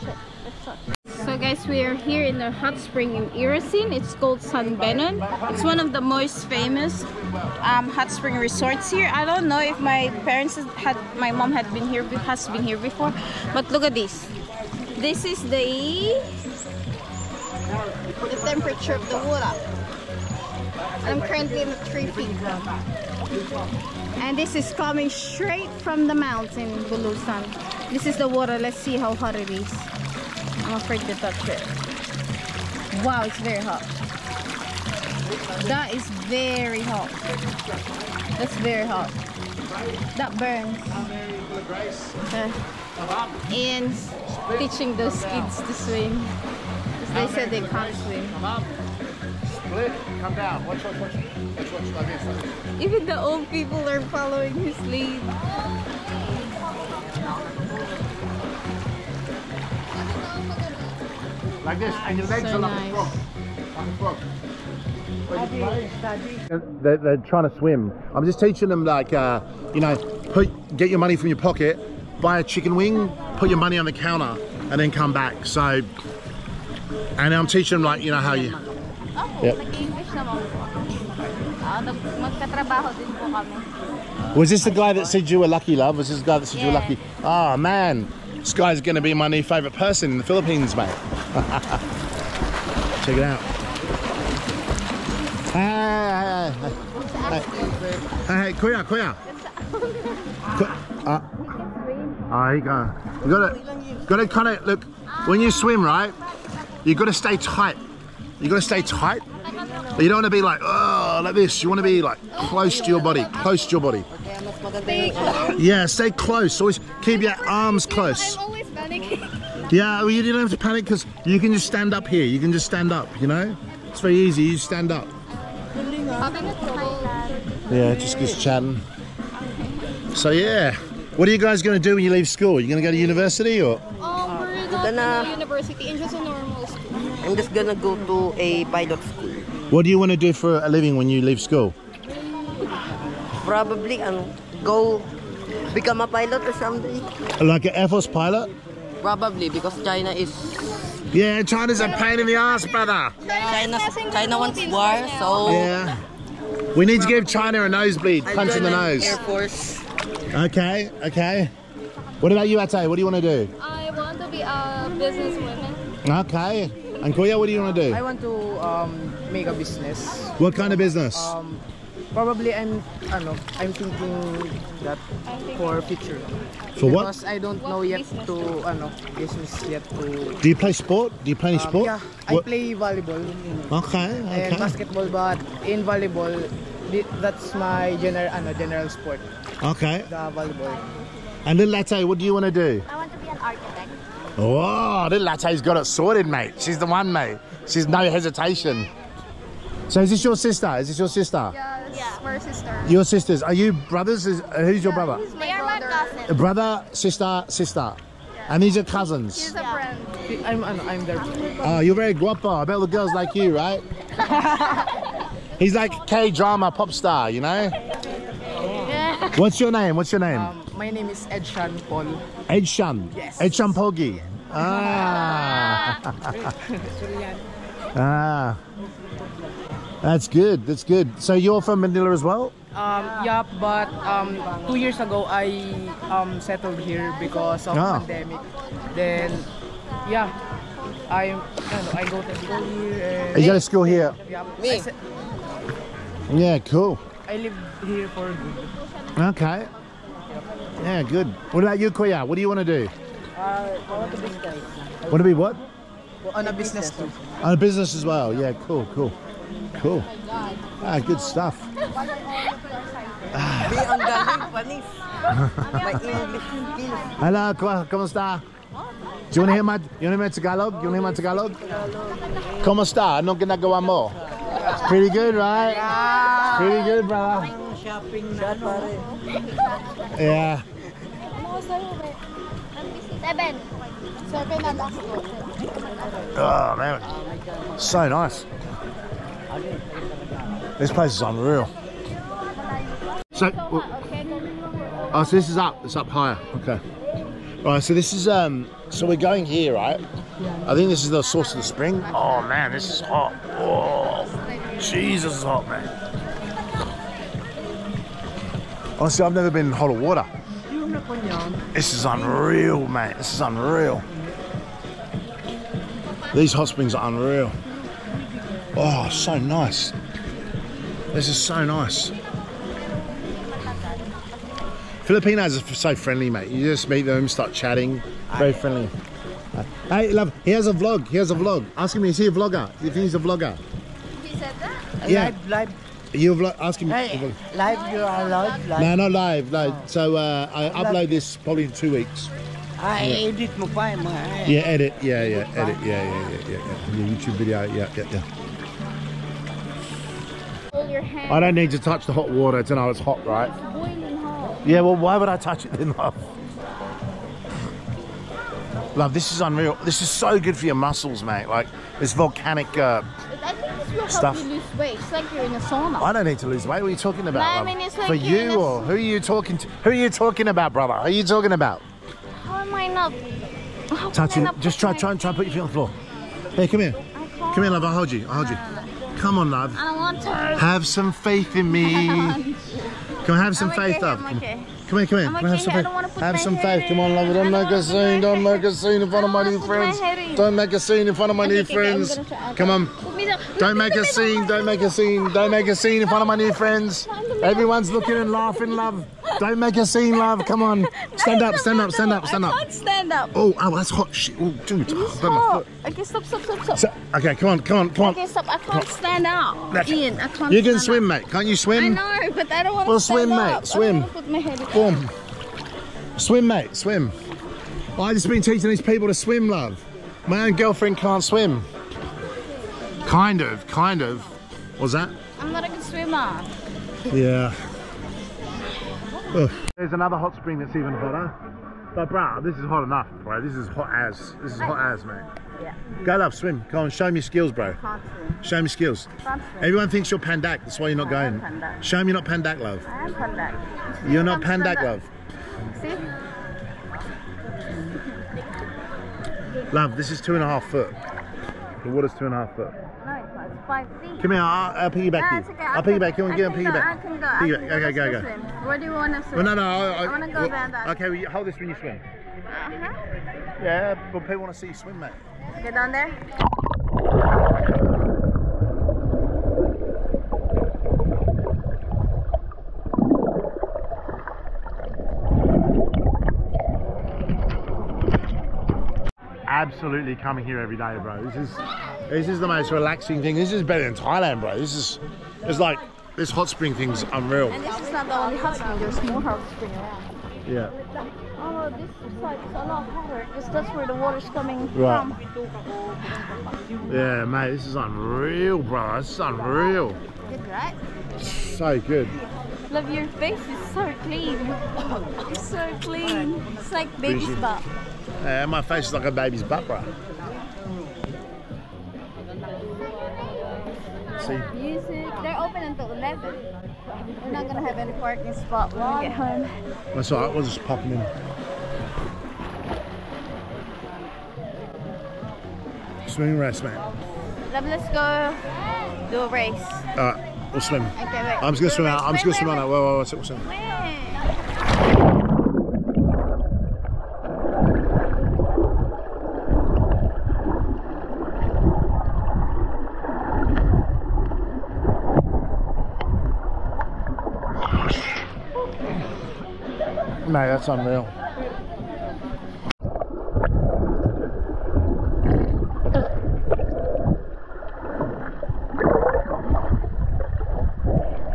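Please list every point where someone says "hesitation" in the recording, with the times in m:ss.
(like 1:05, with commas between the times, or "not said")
3:18.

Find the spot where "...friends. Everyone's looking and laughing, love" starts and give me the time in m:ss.
6:36.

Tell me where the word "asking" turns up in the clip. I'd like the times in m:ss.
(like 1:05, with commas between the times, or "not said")
5:36.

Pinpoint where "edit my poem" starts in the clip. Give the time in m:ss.
5:43.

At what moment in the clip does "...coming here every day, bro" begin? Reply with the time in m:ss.
8:00.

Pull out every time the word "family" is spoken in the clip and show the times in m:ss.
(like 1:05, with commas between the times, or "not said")
not said.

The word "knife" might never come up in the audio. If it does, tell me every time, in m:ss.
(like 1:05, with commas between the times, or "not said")
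not said.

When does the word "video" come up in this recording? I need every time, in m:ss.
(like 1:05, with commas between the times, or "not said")
5:47.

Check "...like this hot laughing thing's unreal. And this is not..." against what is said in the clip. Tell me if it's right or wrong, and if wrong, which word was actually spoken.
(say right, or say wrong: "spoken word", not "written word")
wrong: "spring", not "laughing".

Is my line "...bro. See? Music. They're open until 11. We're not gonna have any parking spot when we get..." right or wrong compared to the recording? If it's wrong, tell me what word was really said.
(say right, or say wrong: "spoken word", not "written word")
right.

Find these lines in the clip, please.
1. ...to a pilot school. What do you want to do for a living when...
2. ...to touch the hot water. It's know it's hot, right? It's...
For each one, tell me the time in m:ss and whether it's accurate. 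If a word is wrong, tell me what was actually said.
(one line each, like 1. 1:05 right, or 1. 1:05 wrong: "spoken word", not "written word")
1. 2:18 right
2. 5:51 right.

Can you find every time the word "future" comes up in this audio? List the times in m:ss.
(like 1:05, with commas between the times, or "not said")
2:55.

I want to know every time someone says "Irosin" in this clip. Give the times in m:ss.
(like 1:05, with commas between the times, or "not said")
0:03.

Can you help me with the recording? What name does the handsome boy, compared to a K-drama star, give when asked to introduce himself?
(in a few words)
Edshan Paul.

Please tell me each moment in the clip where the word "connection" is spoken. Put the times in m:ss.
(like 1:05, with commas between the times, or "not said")
not said.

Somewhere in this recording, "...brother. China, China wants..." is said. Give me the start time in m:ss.
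2:32.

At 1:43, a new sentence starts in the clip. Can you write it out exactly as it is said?
You gotta, gotta kind of, look, when you swim, right, you gotta stay tight.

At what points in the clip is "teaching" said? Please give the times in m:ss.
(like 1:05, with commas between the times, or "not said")
0:44, 1:08, 1:17, 6:58.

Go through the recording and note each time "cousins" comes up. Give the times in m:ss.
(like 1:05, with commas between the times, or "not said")
3:28.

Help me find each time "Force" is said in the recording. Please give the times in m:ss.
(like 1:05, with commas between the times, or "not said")
2:27, 2:39.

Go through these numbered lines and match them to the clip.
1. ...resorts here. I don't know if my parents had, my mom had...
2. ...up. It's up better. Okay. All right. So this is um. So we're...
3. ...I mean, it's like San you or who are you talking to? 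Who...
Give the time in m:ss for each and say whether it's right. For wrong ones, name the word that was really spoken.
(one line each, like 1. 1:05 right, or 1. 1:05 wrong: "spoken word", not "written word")
1. 0:08 right
2. 4:55 wrong: "higher", not "better"
3. 6:07 wrong: "For", not "San".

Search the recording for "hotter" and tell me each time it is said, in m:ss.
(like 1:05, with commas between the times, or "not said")
5:09, 7:10, 8:12.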